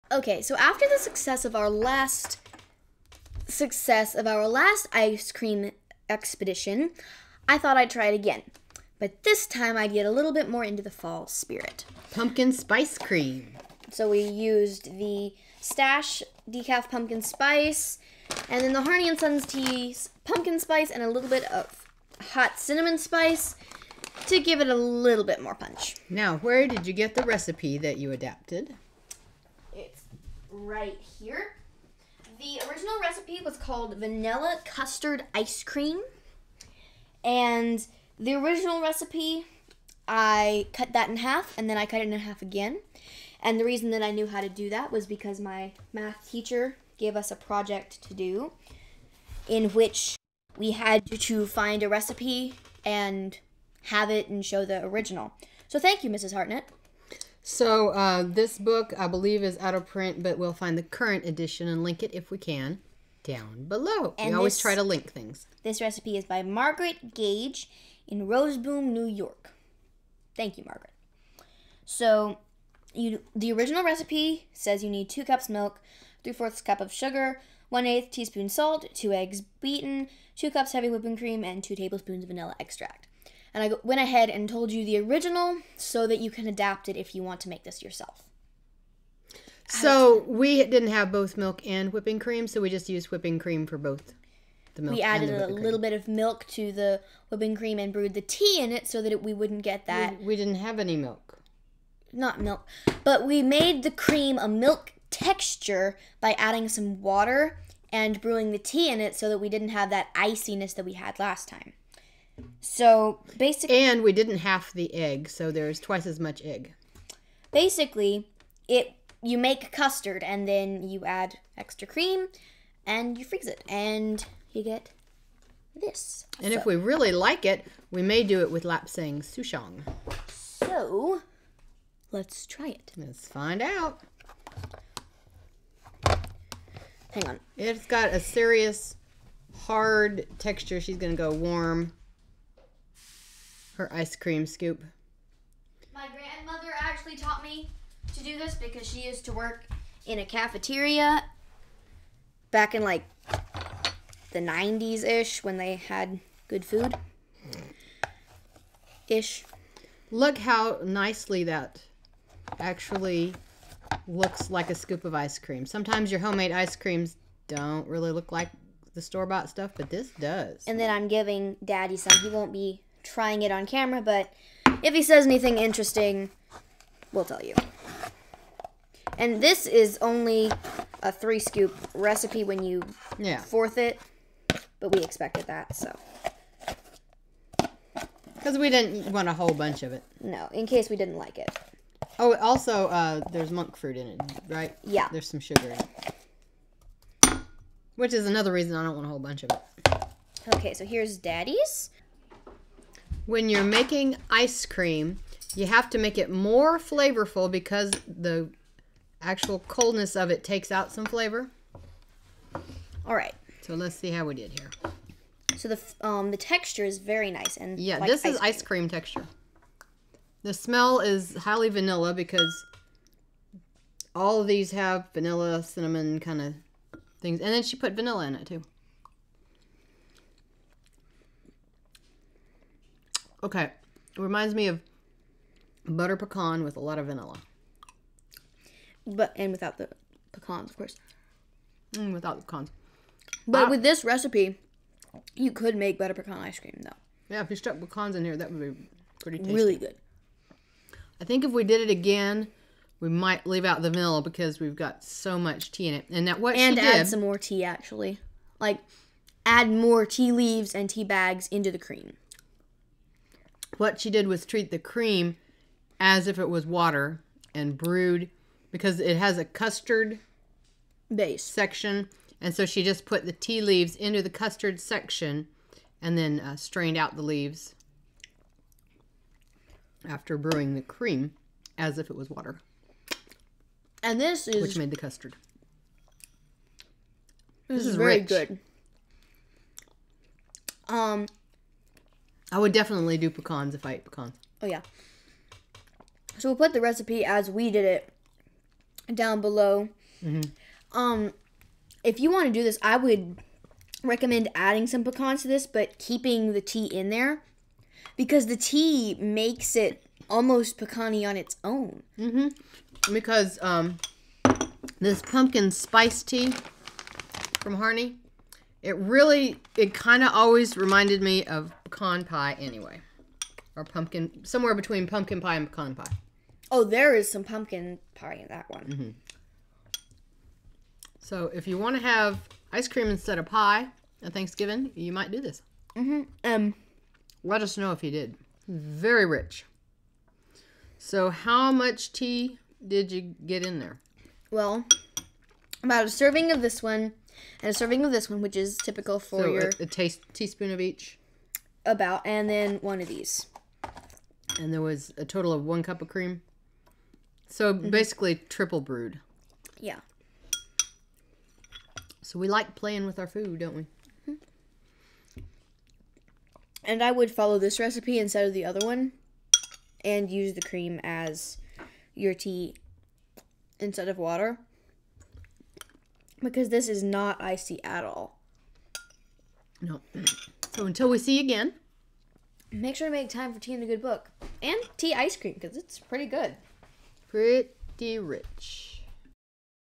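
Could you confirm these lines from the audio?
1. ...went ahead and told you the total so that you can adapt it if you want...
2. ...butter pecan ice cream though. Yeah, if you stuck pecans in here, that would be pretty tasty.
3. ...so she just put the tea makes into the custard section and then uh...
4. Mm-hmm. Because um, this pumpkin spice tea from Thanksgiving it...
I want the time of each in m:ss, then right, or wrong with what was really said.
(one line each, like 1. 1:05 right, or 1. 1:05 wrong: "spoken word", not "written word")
1. 1:23 wrong: "original", not "total"
2. 4:05 right
3. 4:32 wrong: "leaves", not "makes"
4. 5:12 wrong: "Harney", not "Thanksgiving".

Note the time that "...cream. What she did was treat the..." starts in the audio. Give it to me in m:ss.
4:21.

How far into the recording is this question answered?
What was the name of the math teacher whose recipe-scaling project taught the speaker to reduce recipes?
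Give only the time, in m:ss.
0:56.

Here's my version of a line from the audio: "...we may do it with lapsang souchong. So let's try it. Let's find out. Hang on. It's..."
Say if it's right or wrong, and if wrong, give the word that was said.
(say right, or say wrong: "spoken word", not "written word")
right.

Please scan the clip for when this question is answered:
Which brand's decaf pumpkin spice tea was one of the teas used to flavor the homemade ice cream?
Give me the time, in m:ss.
0:15.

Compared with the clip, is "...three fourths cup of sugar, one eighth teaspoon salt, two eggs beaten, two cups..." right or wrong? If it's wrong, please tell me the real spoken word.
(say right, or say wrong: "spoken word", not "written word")
right.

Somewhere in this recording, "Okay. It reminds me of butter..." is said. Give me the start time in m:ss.
3:53.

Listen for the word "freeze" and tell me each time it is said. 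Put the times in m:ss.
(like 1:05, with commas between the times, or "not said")
2:03.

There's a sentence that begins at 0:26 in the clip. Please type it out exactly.
Now, where did you get the recipe that you adapted?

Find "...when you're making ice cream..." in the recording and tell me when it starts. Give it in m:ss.
3:23.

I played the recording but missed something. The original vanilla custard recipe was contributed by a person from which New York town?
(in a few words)
Roseboom.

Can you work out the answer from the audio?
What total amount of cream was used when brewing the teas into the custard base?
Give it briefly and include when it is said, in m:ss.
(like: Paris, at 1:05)
1 cup, at 5:55.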